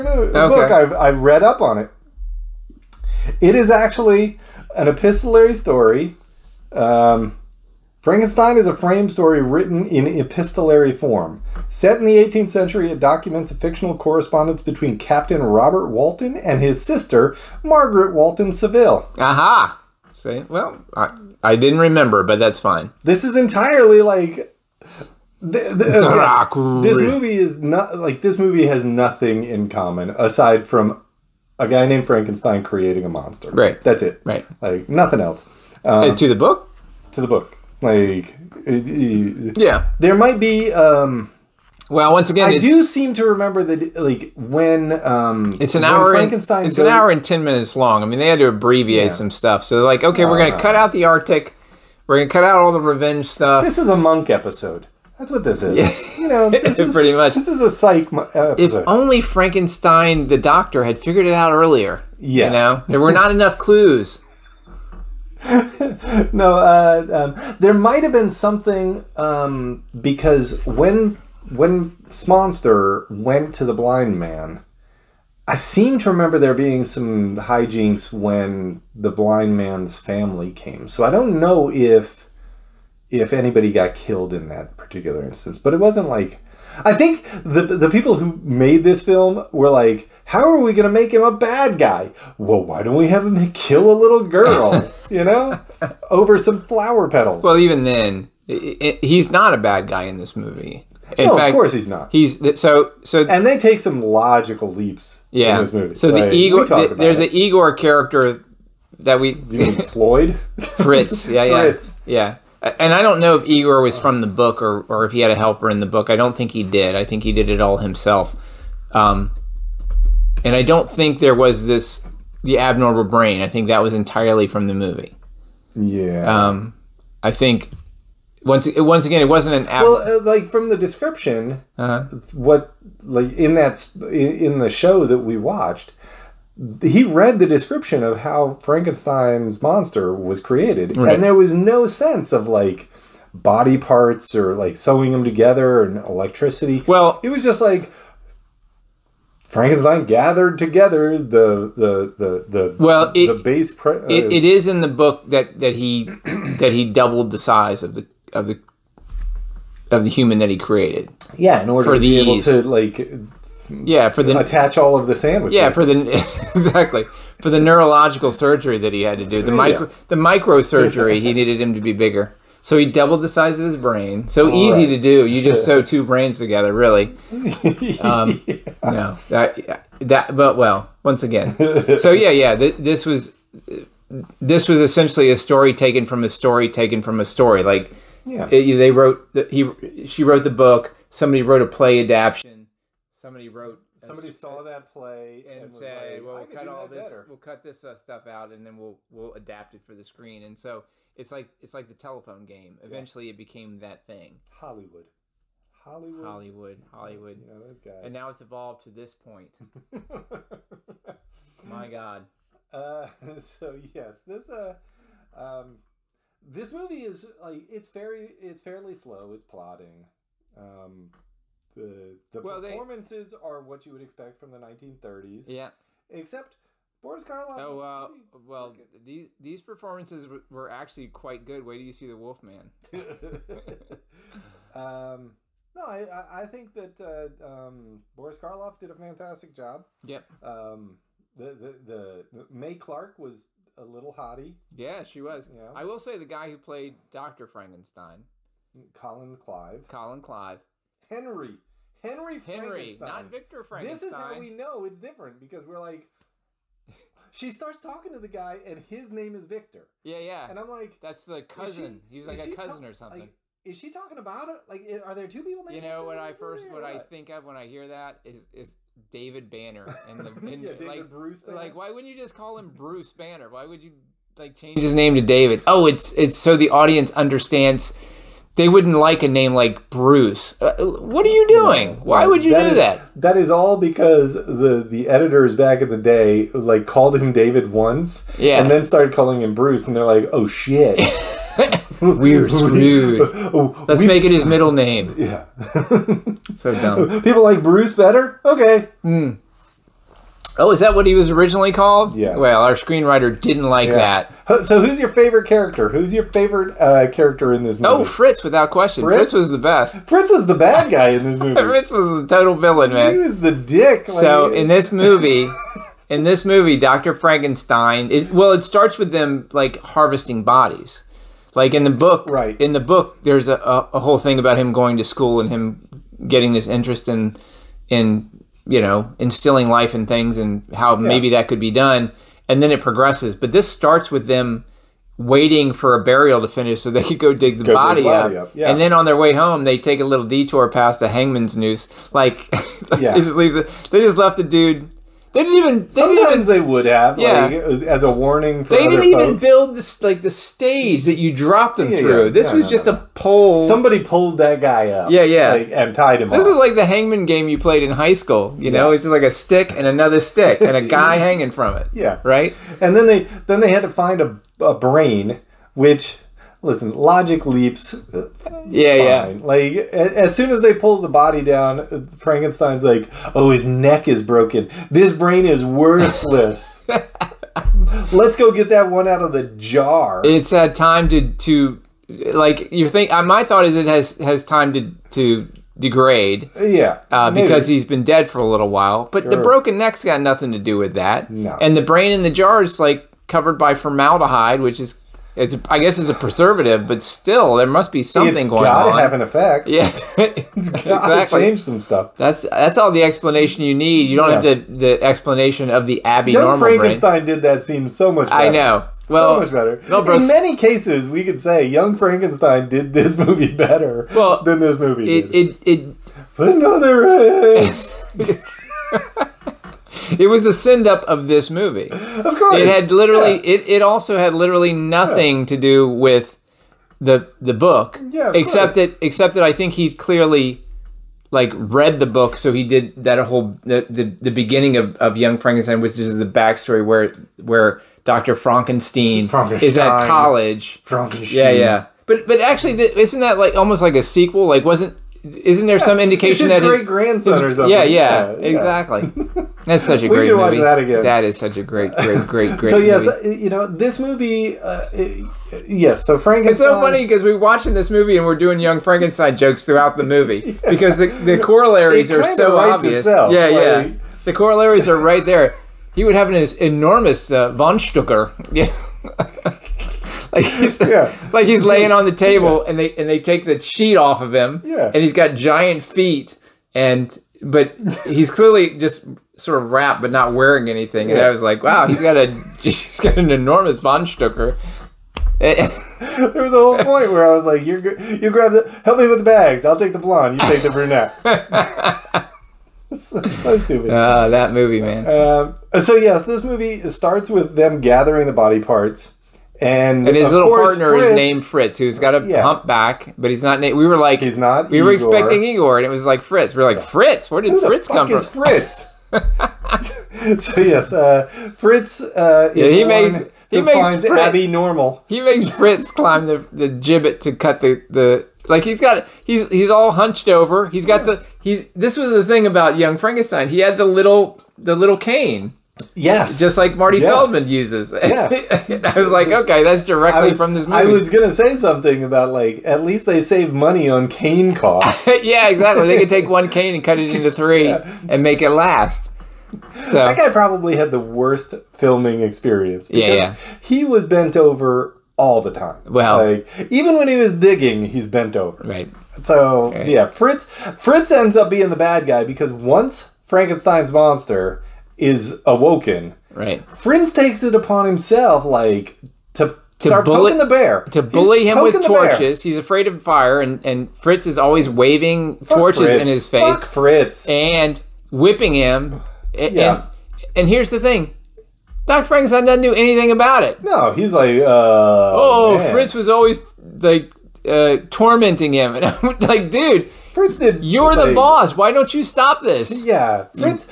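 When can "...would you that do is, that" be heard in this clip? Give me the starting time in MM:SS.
04:42.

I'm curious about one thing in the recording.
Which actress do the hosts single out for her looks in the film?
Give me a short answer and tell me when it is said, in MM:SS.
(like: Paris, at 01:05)
Mae Clarke, at 04:02.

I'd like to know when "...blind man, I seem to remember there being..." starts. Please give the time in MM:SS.
01:13.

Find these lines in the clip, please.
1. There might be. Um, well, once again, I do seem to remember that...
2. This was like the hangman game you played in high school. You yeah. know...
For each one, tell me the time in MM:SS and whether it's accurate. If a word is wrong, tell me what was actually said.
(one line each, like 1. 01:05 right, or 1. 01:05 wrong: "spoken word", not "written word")
1. 00:39 right
2. 05:56 right.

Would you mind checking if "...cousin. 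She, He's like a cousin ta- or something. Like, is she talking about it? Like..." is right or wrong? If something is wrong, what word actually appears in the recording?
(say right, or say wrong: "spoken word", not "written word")
right.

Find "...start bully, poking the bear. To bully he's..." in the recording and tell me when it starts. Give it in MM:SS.
09:19.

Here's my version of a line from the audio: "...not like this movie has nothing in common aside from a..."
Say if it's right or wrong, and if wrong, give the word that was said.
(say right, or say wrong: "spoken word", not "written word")
right.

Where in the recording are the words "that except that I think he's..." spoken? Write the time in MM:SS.
07:08.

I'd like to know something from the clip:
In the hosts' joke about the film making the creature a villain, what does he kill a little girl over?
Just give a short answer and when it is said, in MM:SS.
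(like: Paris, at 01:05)
Flower petals, at 01:36.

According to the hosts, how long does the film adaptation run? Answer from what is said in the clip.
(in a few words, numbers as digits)
An hour and ten minutes.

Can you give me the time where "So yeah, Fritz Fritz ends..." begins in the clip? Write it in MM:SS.
09:09.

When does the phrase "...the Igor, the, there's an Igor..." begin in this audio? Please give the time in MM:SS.
01:46.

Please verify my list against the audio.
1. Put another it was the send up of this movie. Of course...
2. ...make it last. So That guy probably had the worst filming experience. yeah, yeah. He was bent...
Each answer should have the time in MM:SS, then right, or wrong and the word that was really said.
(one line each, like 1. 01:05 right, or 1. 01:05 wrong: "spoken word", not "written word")
1. 06:56 right
2. 08:58 right.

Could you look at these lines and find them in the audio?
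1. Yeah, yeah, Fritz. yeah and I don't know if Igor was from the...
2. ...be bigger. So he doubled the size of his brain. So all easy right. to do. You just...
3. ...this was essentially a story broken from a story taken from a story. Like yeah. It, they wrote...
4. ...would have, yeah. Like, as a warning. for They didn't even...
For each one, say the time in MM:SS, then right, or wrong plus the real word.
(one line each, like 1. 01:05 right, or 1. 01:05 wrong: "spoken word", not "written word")
1. 01:51 right
2. 02:51 right
3. 03:04 wrong: "taken", not "broken"
4. 05:46 right.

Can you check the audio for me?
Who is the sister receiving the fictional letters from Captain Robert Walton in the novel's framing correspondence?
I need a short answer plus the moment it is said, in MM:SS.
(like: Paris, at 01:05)
Margaret Walton Saville, at 00:17.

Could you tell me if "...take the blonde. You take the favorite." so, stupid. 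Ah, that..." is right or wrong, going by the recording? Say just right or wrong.
wrong.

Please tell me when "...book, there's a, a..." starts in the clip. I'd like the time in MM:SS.
05:22.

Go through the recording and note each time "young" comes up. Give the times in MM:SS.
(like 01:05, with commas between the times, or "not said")
06:46, 06:51, 07:15, 07:38, 08:42.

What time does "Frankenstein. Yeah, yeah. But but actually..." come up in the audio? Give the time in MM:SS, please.
07:20.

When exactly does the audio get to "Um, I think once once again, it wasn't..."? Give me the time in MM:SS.
02:06.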